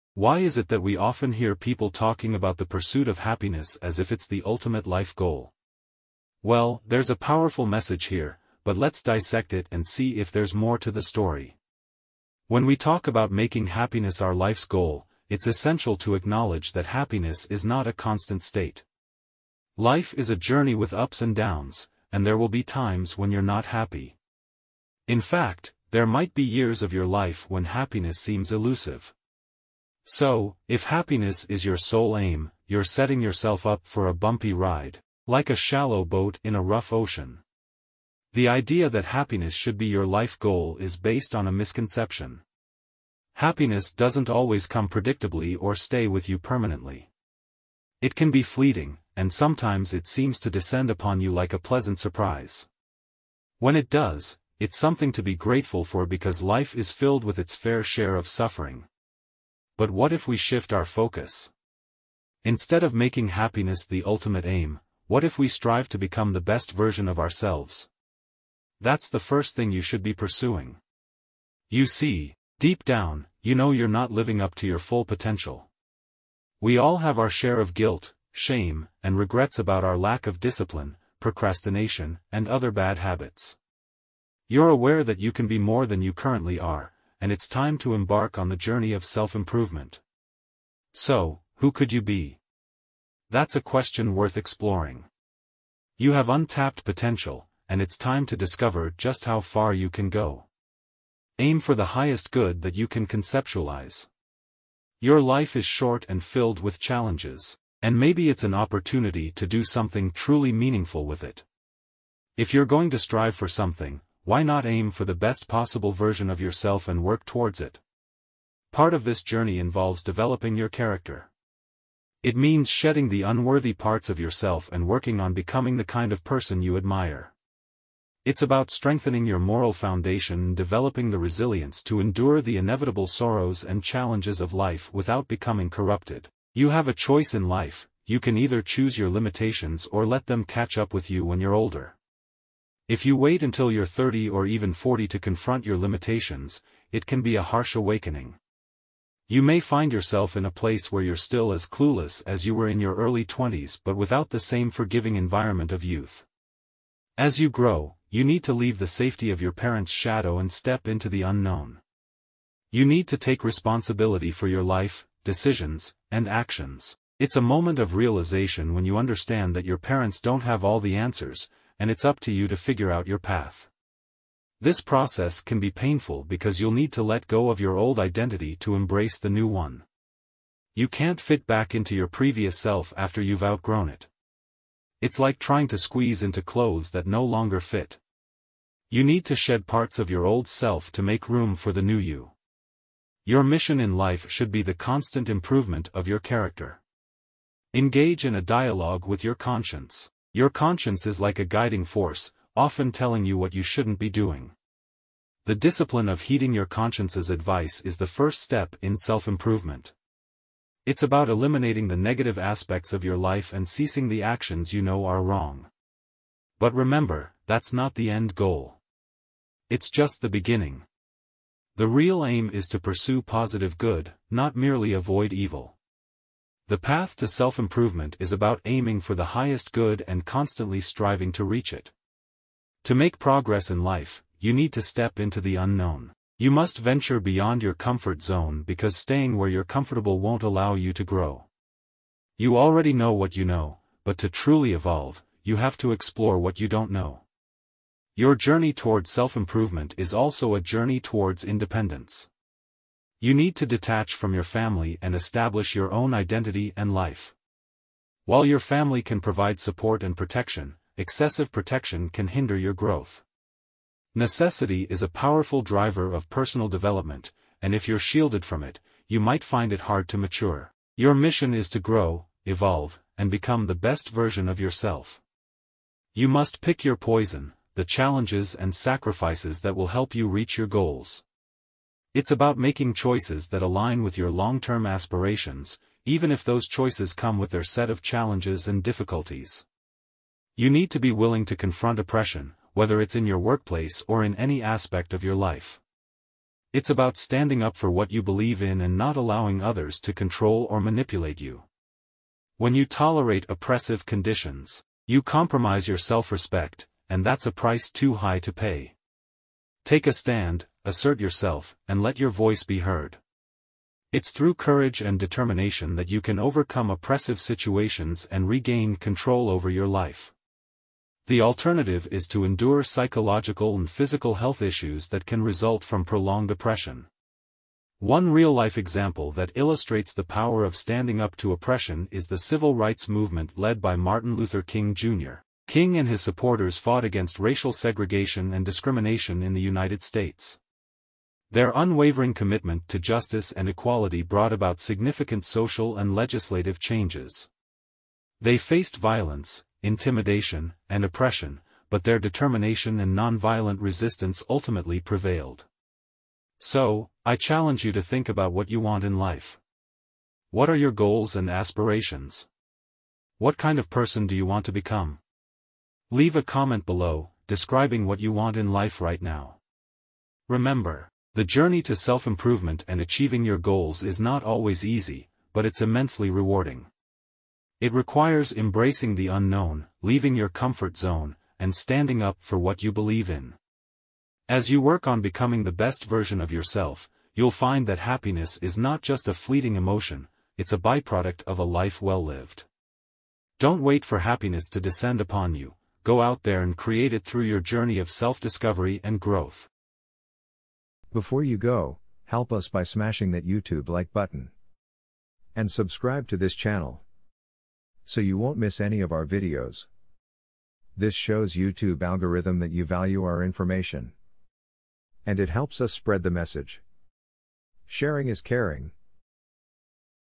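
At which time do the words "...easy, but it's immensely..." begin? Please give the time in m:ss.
6:14.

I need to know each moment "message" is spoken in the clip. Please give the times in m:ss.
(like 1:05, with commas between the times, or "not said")
0:07, 6:56.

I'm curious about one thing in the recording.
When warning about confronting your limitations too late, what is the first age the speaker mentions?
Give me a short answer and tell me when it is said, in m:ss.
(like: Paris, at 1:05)
30, at 2:23.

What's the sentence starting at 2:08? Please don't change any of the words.
It's about strengthening your moral foundation and developing the resilience to endure the inevitable sorrows and challenges of life without becoming corrupted.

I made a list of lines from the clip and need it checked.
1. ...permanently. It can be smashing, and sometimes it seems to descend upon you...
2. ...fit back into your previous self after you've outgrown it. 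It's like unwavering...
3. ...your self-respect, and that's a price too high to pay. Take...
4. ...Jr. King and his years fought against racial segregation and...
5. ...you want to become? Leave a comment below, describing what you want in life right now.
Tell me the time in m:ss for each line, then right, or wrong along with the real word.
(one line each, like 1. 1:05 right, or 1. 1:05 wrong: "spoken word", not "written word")
1. 0:46 wrong: "fleeting", not "smashing"
2. 3:01 wrong: "trying", not "unwavering"
3. 5:05 right
4. 5:34 wrong: "supporters", not "years"
5. 6:04 right.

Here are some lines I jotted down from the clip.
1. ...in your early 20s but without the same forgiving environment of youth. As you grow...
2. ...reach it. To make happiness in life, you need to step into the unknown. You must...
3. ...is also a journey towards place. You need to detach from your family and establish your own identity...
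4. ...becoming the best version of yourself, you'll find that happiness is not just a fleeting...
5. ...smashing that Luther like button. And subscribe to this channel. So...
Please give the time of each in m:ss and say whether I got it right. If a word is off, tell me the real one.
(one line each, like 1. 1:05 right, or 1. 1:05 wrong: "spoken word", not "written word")
1. 2:32 right
2. 3:51 wrong: "progress", not "happiness"
3. 4:09 wrong: "independence", not "place"
4. 6:25 right
5. 6:42 wrong: "YouTube", not "Luther".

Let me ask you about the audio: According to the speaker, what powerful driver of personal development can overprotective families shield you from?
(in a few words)
Necessity.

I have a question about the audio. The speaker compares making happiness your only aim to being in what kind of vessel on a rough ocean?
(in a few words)
shallow boat.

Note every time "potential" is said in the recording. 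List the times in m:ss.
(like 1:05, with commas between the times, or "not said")
1:15, 1:36.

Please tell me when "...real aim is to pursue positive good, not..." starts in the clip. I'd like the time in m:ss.
3:41.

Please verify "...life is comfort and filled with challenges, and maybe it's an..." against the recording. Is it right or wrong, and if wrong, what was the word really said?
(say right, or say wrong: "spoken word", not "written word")
wrong: "short", not "comfort".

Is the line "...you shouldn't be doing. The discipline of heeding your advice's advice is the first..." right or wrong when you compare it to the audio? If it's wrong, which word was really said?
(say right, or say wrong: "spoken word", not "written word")
wrong: "conscience", not "advice".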